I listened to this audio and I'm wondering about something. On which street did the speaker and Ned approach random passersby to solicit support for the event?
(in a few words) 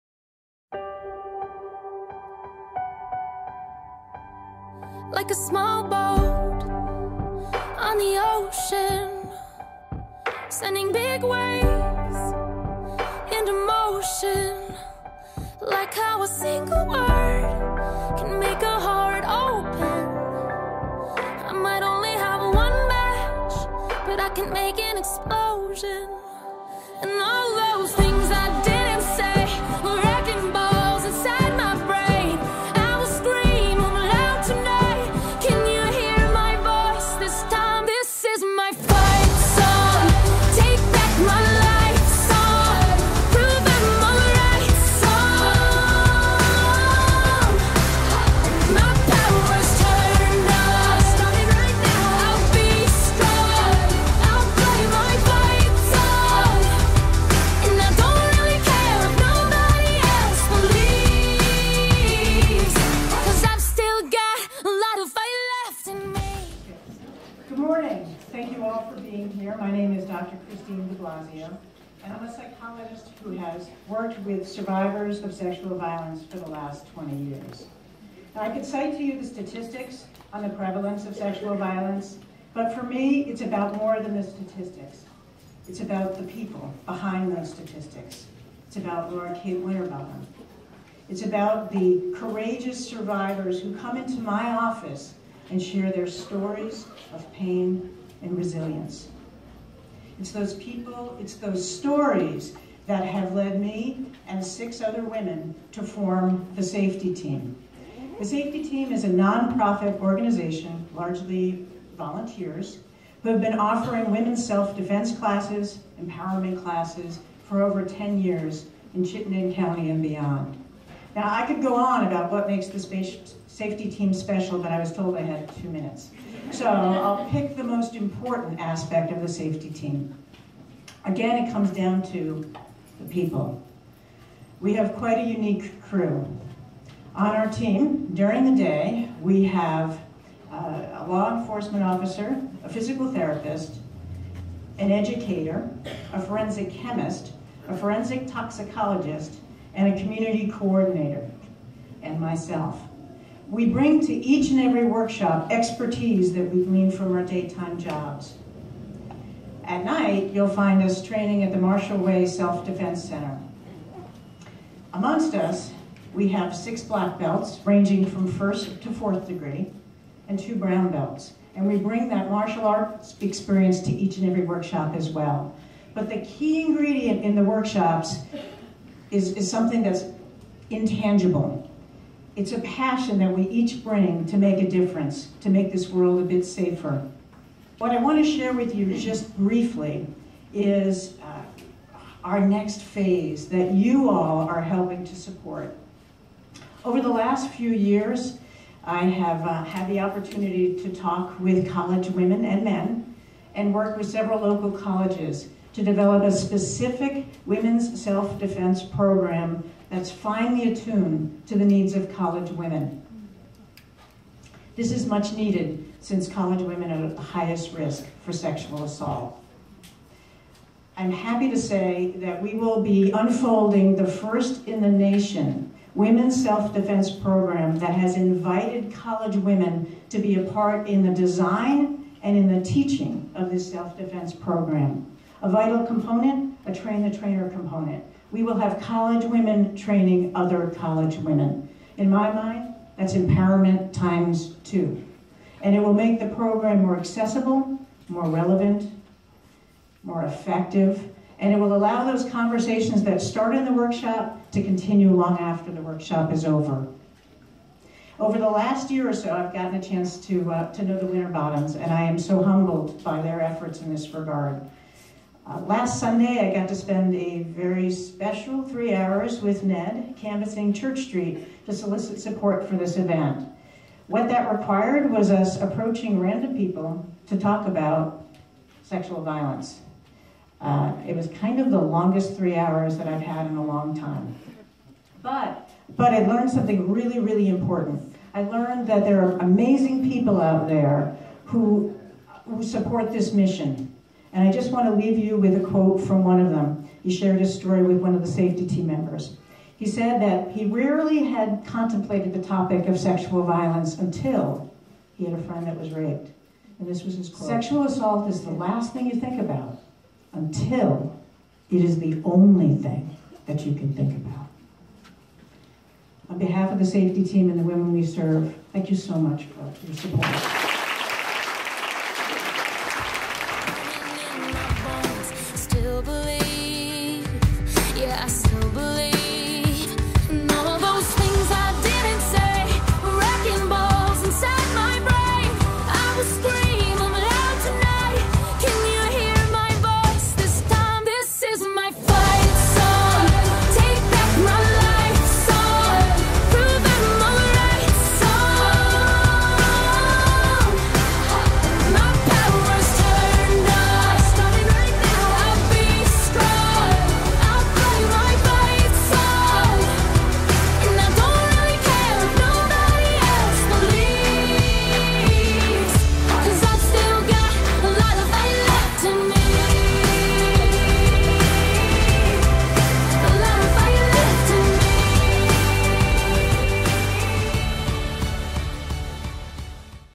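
Church Street.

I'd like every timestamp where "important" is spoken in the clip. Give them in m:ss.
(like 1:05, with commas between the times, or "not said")
2:07, 4:47.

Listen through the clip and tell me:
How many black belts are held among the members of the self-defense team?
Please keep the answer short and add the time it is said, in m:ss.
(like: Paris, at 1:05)
6, at 2:46.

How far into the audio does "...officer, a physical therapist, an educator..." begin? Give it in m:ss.
2:21.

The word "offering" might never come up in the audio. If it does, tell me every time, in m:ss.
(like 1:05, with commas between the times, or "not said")
1:53.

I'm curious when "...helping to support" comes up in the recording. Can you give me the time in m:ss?
3:14.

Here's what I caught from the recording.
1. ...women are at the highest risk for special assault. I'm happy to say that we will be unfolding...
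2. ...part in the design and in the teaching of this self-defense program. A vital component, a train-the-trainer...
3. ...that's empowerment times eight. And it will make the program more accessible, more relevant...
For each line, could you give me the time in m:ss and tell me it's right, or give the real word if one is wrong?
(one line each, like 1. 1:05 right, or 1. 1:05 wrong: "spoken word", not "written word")
1. 3:36 wrong: "sexual", not "special"
2. 3:50 right
3. 4:02 wrong: "two", not "eight".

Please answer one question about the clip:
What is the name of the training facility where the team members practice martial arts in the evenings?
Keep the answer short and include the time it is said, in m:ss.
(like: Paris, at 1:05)
Martial Way Self-Defense Center, at 2:41.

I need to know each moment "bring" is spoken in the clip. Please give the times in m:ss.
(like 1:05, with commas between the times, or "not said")
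2:33, 2:51, 3:03.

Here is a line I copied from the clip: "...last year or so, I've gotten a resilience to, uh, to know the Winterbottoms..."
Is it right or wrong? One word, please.
wrong.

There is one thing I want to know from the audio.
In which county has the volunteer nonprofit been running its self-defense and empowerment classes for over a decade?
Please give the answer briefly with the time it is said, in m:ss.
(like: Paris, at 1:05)
Chittenden County, at 1:59.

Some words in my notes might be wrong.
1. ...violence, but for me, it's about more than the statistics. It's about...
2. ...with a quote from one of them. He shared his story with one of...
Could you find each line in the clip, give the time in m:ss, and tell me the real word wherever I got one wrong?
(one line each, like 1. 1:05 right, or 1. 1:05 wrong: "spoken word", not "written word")
1. 1:21 right
2. 4:55 right.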